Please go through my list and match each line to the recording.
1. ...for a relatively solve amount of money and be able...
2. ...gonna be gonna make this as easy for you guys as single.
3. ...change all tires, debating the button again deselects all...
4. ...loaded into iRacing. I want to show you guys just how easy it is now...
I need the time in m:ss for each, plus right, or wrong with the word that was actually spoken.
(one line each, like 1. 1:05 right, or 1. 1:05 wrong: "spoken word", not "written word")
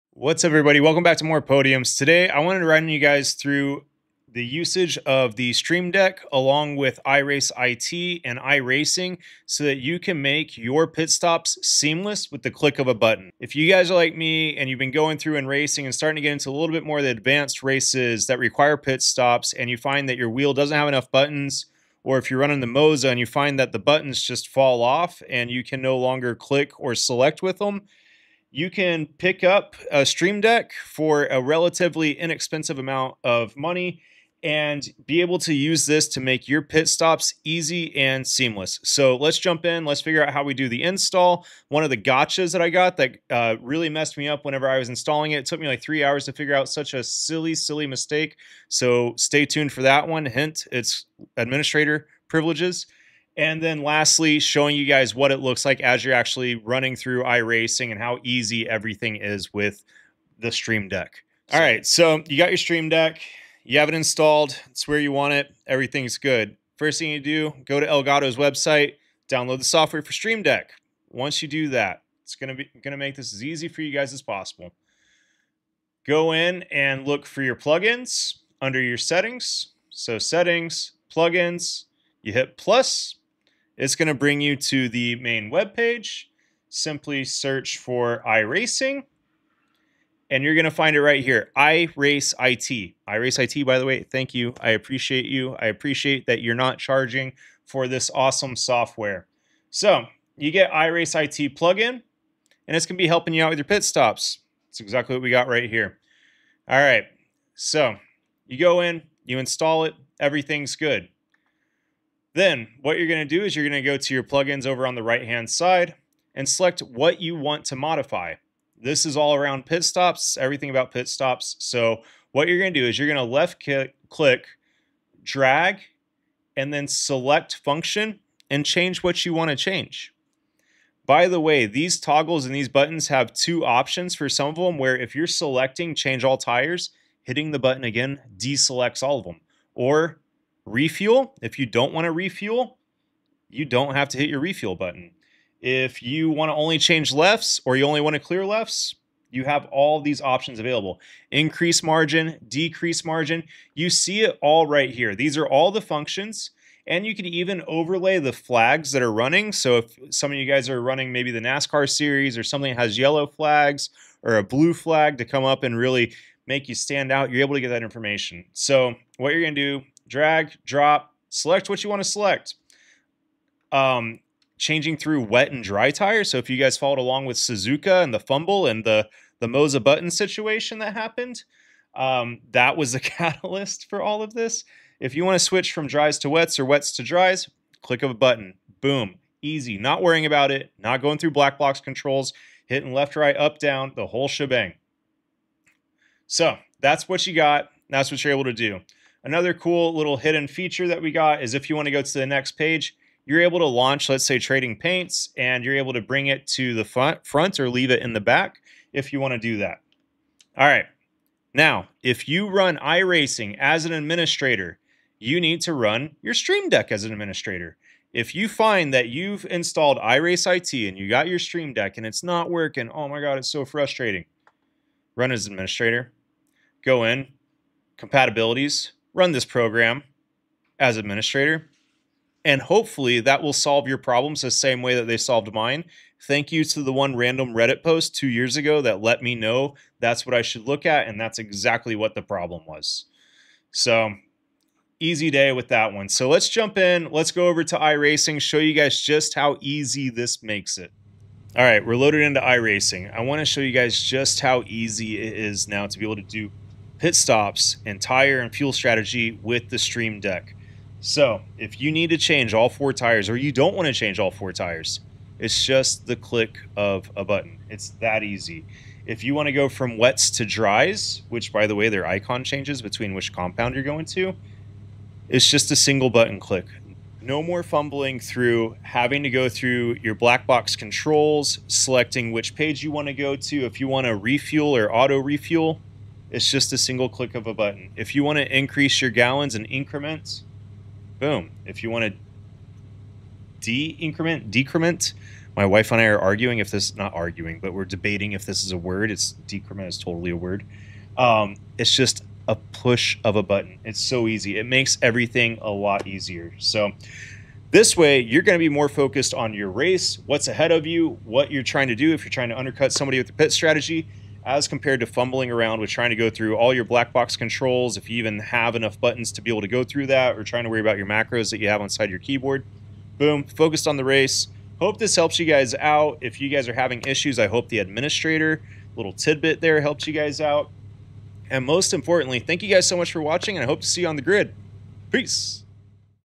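1. 0:30 wrong: "inexpensive", not "solve"
2. 1:12 wrong: "possible", not "single"
3. 2:15 wrong: "hitting", not "debating"
4. 4:11 right.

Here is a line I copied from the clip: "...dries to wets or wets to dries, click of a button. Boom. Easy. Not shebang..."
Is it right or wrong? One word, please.
wrong.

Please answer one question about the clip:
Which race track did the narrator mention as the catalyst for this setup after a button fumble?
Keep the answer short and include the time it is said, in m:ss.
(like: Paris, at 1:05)
Suzuka, at 2:57.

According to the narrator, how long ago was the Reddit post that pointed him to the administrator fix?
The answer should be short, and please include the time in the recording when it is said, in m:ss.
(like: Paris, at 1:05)
2 years, at 3:58.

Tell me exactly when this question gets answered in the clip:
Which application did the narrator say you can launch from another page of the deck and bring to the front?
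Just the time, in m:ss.
3:24.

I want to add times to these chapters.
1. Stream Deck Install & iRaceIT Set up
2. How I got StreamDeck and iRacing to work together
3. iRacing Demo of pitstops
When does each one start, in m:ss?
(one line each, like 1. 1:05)
1. 1:00
2. 3:30
3. 4:11.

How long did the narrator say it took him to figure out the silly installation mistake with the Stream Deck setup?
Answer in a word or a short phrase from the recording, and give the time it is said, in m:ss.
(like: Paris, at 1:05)
3 hours, at 0:45.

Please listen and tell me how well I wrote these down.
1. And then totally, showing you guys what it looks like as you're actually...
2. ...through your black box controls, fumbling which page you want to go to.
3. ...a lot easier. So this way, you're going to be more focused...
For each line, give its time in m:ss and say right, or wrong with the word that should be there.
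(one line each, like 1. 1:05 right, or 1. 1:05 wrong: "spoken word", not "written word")
1. 0:53 wrong: "lastly", not "totally"
2. 4:39 wrong: "selecting", not "fumbling"
3. 5:05 right.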